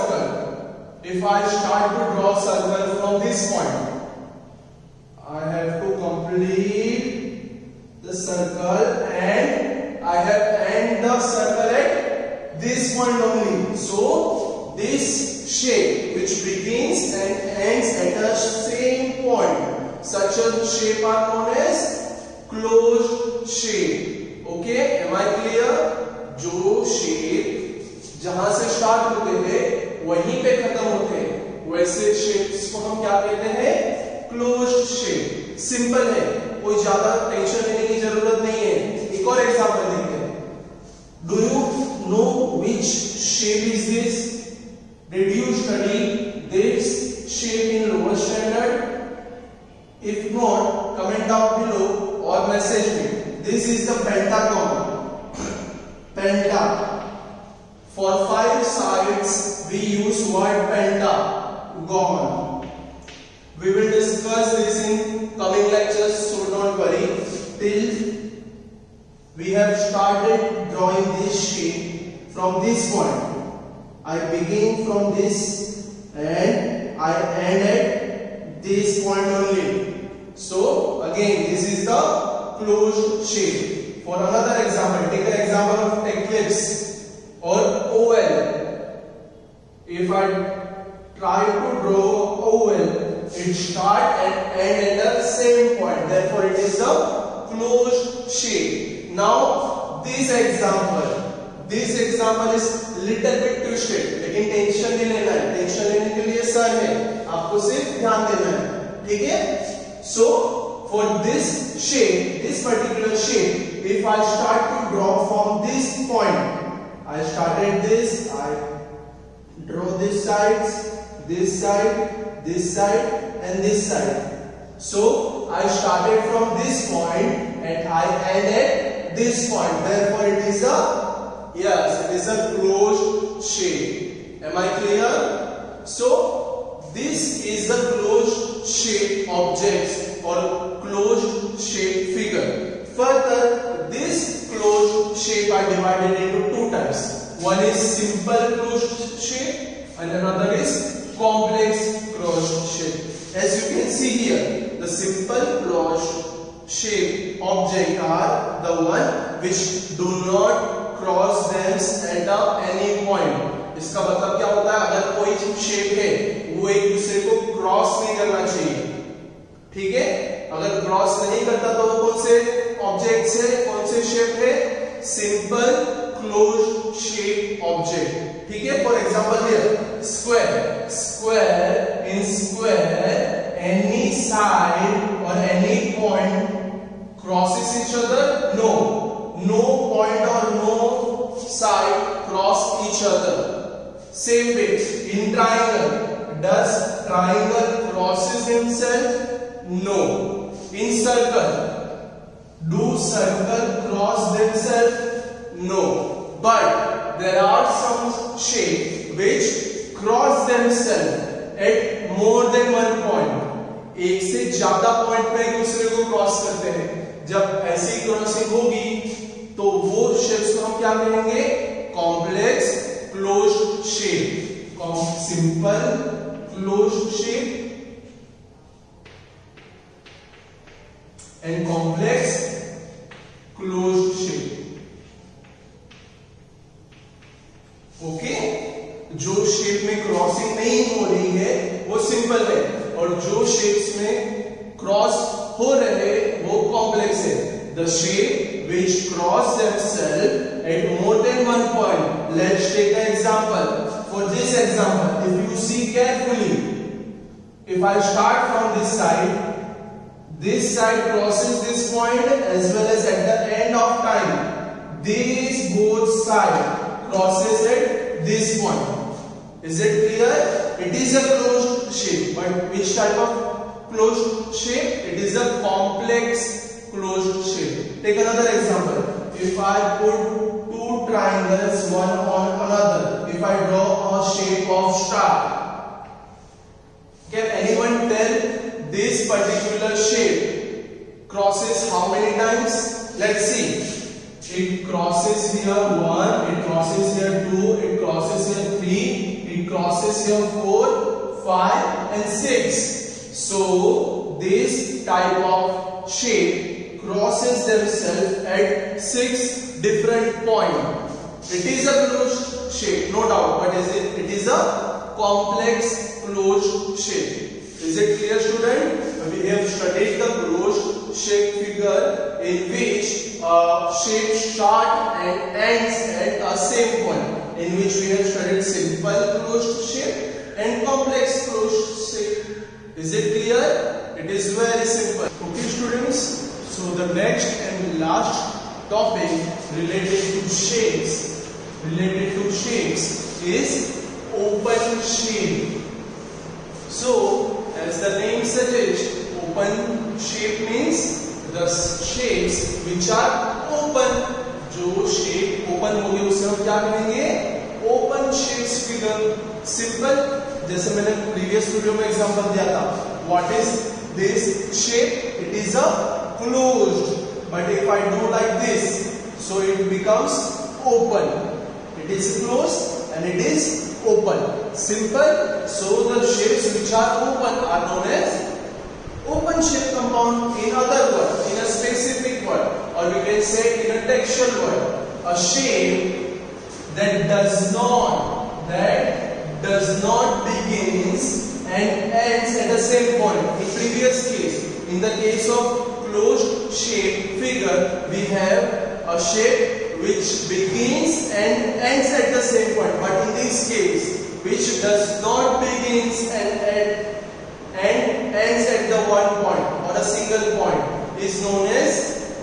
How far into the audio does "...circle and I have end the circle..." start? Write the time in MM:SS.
00:08.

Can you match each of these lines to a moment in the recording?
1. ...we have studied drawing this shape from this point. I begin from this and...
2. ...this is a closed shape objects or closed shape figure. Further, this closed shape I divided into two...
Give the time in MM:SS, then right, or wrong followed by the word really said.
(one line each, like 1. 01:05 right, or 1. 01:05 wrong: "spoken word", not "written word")
1. 01:09 wrong: "started", not "studied"
2. 02:16 right.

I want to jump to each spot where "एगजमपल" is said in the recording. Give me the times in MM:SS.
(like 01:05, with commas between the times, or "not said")
00:39, 02:58.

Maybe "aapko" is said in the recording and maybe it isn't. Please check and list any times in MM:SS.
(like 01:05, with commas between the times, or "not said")
01:47.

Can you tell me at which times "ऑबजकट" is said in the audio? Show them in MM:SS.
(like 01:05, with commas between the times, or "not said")
02:52, 02:57.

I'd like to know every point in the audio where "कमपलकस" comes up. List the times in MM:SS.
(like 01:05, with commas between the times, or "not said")
03:41, 03:51, 04:06.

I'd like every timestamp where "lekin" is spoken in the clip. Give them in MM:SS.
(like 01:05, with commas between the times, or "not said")
01:44.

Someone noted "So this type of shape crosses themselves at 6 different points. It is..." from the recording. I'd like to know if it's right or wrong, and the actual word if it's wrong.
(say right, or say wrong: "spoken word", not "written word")
right.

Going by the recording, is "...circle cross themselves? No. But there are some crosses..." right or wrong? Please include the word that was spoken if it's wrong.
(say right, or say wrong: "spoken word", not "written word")
wrong: "shapes", not "crosses".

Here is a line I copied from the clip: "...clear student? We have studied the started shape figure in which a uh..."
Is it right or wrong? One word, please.
wrong.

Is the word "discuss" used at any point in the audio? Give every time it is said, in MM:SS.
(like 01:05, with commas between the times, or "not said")
01:03.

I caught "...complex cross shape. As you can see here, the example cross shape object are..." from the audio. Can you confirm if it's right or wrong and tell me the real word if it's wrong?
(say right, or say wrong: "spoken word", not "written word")
wrong: "simple", not "example".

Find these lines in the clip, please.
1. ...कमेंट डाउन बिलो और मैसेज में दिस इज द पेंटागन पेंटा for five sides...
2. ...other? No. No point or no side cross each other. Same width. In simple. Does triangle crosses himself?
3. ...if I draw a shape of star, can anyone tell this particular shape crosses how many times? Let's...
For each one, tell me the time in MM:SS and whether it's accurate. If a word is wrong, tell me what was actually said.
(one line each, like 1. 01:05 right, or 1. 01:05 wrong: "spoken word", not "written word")
1. 00:50 right
2. 03:08 wrong: "triangle", not "simple"
3. 04:43 right.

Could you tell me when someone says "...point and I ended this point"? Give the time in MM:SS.
02:06.